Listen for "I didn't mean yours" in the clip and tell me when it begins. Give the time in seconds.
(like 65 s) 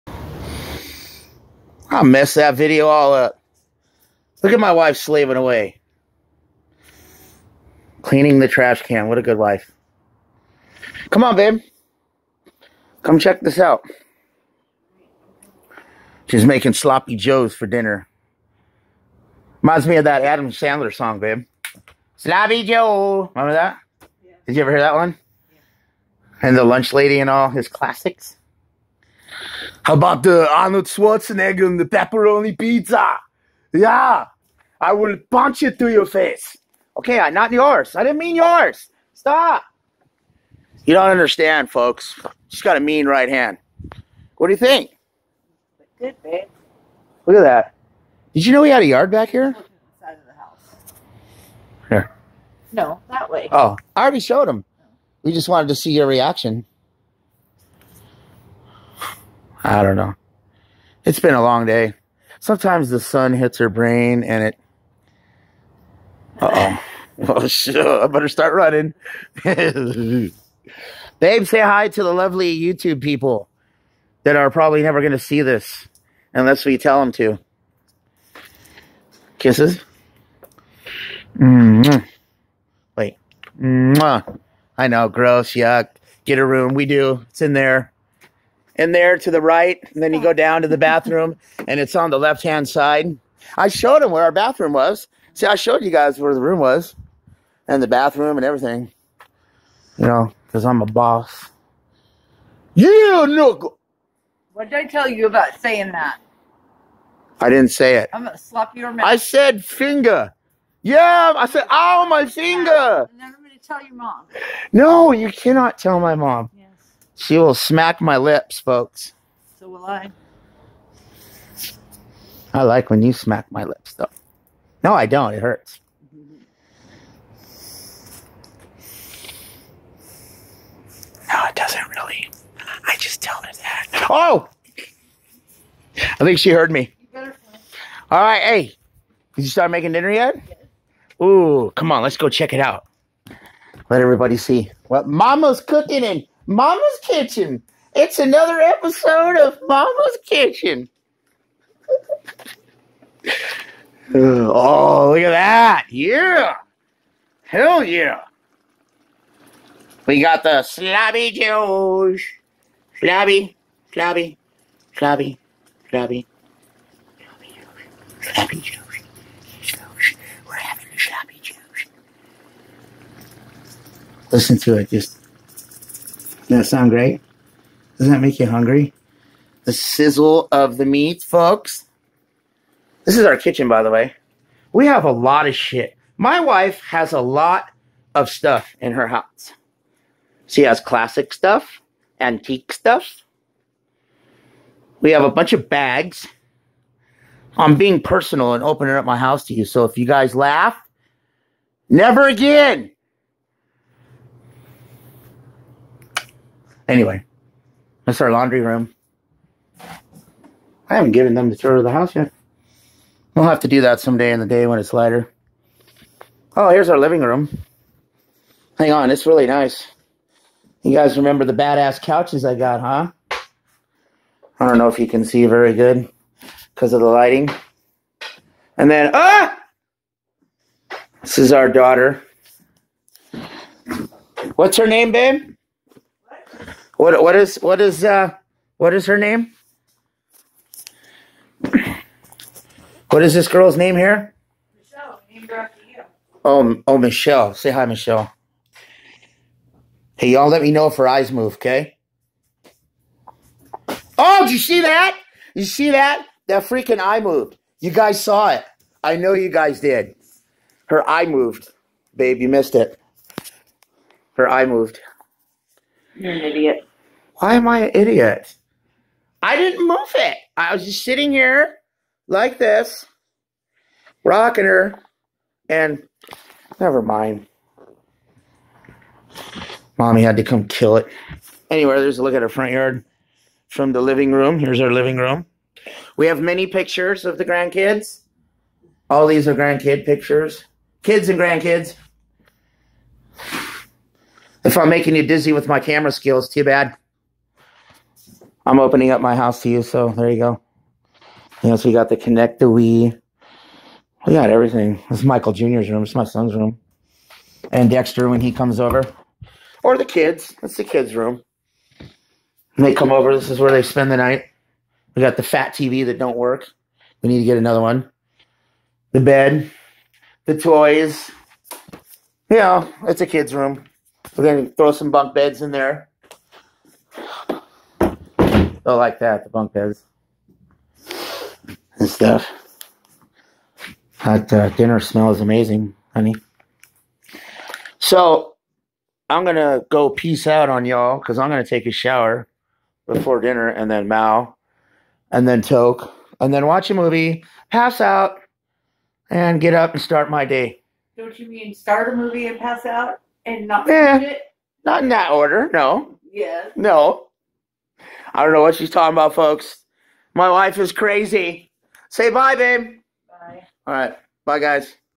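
37 s.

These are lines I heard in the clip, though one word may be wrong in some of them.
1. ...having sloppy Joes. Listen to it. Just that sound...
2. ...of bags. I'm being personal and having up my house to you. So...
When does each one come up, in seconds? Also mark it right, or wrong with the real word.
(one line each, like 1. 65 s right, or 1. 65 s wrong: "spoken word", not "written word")
1. 170 s right
2. 195 s wrong: "opening", not "having".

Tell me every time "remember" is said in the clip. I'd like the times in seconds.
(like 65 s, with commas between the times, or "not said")
23 s, 221 s.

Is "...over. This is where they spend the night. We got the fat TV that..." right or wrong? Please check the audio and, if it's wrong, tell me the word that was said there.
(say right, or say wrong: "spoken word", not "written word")
right.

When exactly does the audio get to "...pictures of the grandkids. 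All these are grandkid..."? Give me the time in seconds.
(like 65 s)
286 s.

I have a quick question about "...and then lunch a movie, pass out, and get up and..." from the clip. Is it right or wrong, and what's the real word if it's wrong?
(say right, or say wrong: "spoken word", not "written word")
wrong: "watch", not "lunch".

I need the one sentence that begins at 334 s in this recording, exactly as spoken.
That uh, dinner smell is amazing, honey.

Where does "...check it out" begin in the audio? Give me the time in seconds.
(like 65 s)
142 s.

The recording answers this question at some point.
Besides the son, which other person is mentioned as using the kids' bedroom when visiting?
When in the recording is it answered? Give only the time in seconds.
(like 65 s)
307 s.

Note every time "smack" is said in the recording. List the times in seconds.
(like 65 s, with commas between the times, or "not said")
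117 s, 123 s.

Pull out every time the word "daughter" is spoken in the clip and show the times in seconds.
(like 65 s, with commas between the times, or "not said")
231 s.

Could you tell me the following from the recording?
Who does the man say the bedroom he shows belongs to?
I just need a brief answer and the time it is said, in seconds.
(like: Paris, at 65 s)
Michael Jr., at 305 s.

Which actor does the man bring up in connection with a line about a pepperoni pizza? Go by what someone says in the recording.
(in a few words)
Arnold Schwarzenegger.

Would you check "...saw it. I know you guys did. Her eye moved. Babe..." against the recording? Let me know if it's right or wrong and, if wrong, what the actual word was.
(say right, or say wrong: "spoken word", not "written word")
right.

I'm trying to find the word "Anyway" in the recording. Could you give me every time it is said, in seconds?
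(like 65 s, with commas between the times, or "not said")
206 s, 281 s.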